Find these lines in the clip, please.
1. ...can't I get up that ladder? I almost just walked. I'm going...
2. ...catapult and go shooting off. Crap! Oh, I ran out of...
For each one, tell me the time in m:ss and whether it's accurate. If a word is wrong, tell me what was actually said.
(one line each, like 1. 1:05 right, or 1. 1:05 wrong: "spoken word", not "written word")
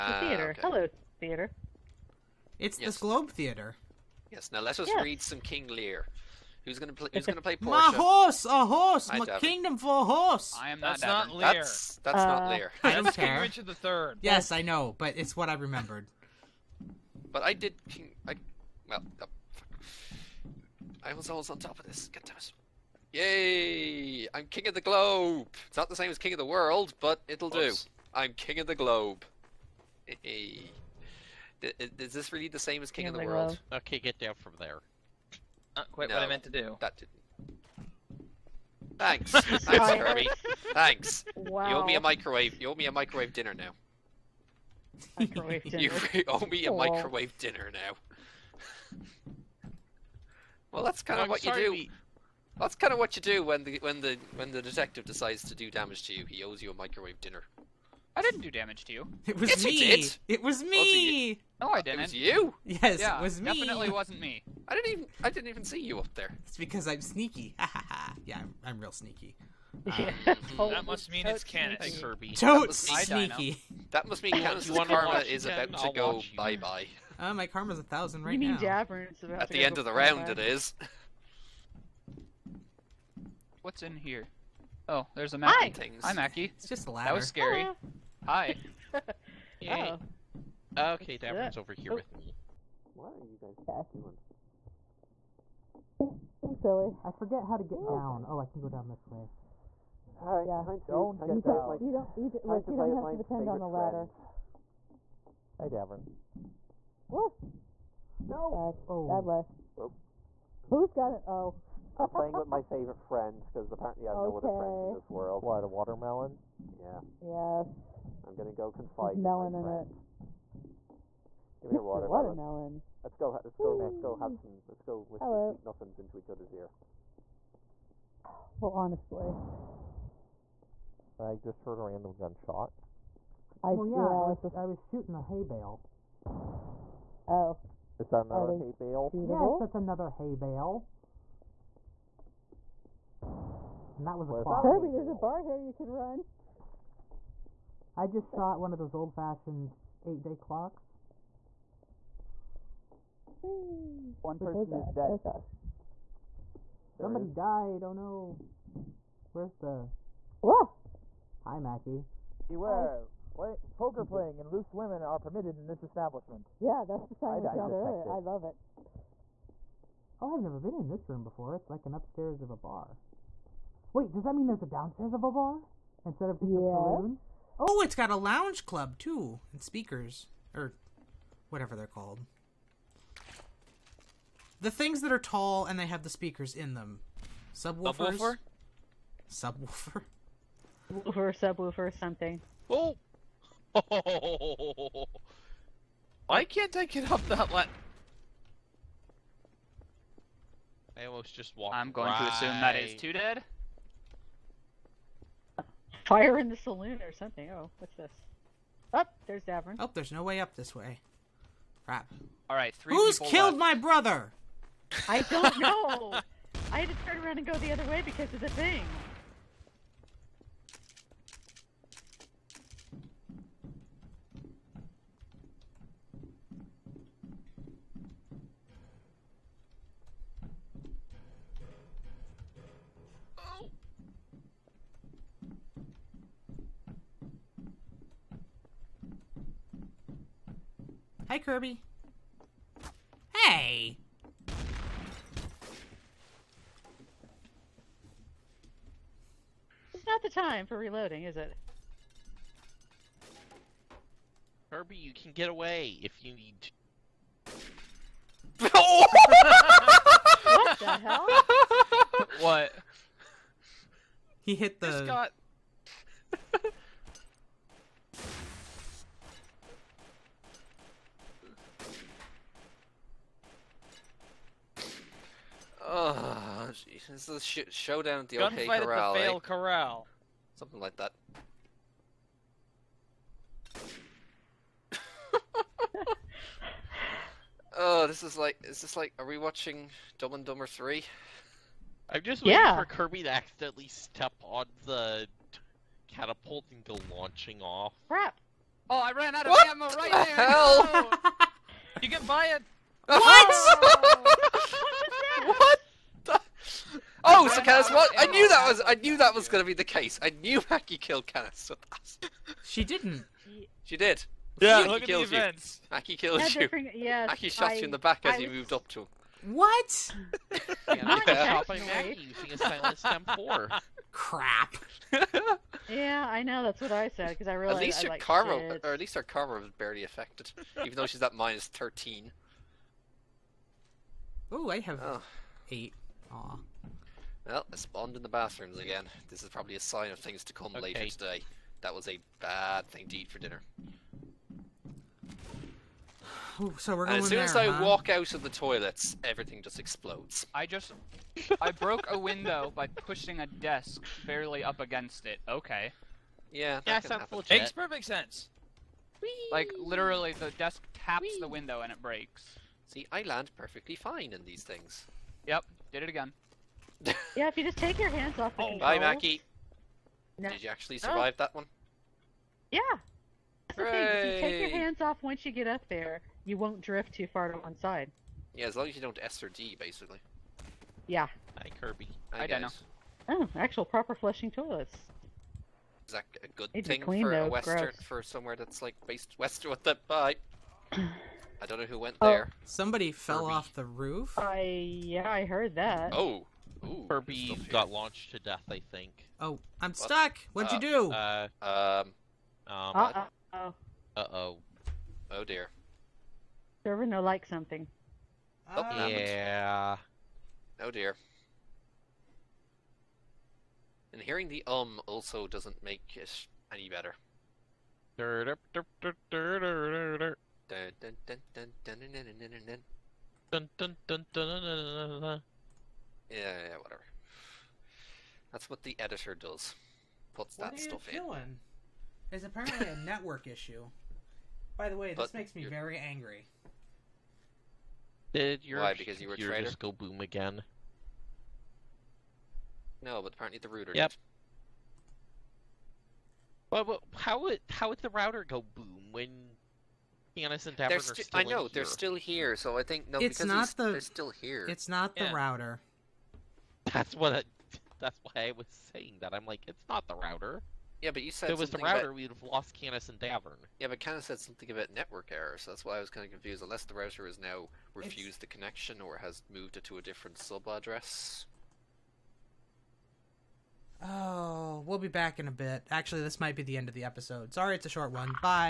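1. 3:16 right
2. 4:56 wrong: "launching", not "shooting".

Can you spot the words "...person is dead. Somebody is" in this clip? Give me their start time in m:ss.
2:34.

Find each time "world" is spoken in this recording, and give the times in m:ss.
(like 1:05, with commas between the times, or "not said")
0:26, 0:33, 1:55.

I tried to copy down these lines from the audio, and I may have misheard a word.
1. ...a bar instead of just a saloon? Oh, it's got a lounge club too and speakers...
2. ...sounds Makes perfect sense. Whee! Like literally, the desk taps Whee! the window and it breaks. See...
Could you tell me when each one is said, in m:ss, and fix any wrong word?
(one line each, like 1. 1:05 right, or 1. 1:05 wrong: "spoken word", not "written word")
1. 2:55 right
2. 5:57 right.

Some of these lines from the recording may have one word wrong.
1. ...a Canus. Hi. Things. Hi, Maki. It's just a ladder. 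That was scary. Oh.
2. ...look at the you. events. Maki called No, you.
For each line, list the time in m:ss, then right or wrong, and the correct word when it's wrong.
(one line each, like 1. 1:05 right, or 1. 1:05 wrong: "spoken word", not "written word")
1. 1:25 wrong: "Maki", not "Canus"
2. 5:14 wrong: "killed", not "called".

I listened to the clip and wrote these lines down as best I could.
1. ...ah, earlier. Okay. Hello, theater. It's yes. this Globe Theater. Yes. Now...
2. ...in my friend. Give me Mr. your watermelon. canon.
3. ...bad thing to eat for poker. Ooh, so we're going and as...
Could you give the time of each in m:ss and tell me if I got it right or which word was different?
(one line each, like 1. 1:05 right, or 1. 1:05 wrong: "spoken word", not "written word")
1. 0:00 wrong: "theater", not "earlier"
2. 1:59 wrong: "watermelon", not "canon"
3. 5:42 wrong: "dinner", not "poker".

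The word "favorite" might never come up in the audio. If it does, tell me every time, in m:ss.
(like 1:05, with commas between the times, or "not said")
1:43, 1:52.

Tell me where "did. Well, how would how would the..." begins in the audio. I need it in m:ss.
7:24.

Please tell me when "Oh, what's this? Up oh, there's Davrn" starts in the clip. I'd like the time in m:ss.
3:27.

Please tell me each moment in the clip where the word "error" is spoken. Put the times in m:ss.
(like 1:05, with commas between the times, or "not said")
7:45.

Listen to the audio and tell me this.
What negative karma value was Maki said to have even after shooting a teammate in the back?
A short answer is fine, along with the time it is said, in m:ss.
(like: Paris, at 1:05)
-13, at 5:31.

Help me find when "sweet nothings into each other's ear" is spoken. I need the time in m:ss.
2:05.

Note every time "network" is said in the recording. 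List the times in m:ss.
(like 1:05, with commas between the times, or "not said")
7:13, 7:44.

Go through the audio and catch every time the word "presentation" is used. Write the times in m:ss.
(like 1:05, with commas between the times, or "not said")
not said.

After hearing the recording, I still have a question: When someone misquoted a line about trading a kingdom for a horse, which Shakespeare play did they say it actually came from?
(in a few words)
Richard the Third.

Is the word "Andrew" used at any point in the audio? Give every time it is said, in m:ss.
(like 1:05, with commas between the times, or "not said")
not said.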